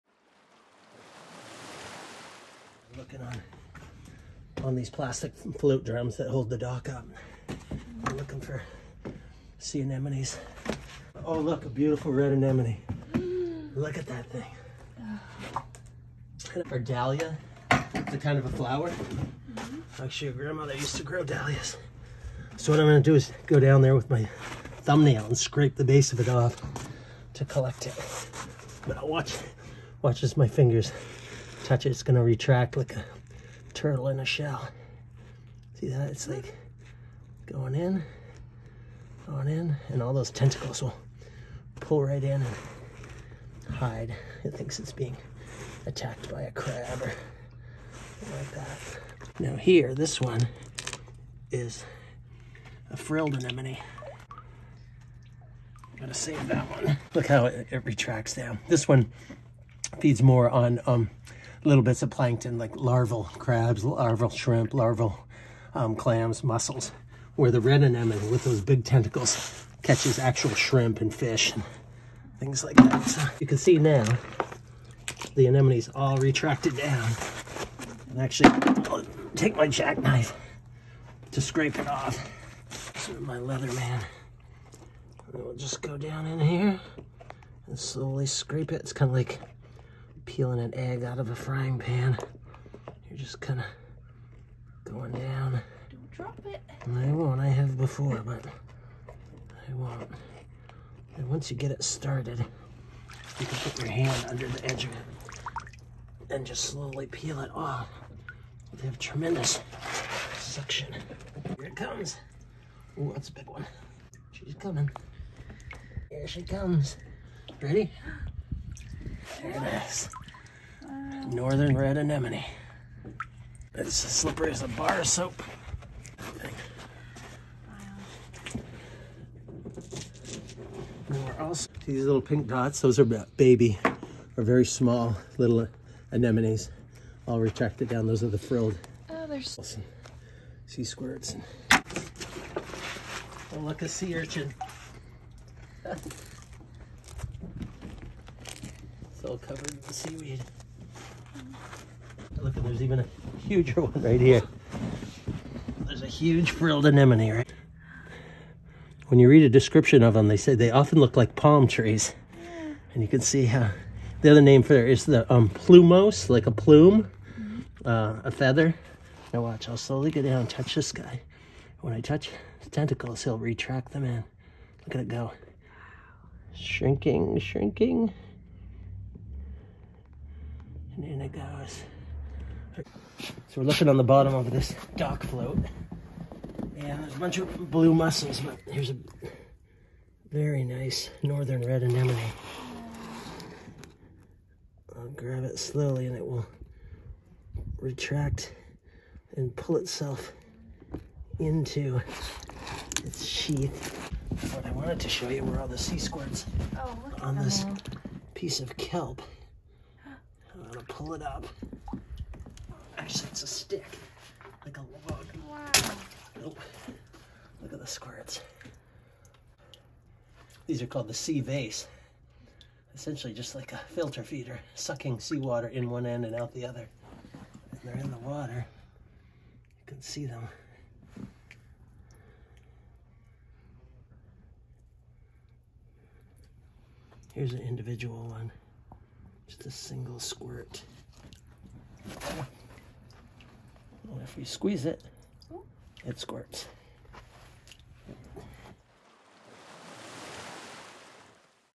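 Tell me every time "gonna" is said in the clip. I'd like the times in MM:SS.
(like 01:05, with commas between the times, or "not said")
00:22, 00:32, 00:55.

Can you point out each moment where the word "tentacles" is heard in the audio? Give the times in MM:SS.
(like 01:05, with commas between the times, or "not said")
00:40, 01:08, 02:52.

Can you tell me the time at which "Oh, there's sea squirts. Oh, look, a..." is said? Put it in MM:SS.
02:19.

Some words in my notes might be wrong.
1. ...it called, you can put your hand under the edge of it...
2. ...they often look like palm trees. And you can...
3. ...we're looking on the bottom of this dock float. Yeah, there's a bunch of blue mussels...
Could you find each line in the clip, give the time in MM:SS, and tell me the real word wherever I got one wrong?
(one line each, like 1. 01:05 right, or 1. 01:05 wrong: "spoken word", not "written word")
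1. 01:41 wrong: "started", not "called"
2. 02:40 right
3. 03:03 right.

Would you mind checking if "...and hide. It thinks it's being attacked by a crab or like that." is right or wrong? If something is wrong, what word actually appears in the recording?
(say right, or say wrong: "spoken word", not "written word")
right.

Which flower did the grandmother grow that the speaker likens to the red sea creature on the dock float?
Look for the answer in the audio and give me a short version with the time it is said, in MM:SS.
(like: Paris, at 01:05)
Dahlias, at 00:21.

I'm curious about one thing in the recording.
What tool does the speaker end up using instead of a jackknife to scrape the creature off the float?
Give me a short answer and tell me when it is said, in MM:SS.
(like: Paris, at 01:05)
Leatherman, at 01:23.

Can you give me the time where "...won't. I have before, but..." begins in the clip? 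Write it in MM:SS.
01:37.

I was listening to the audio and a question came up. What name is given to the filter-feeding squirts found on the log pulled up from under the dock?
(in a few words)
Sea vase.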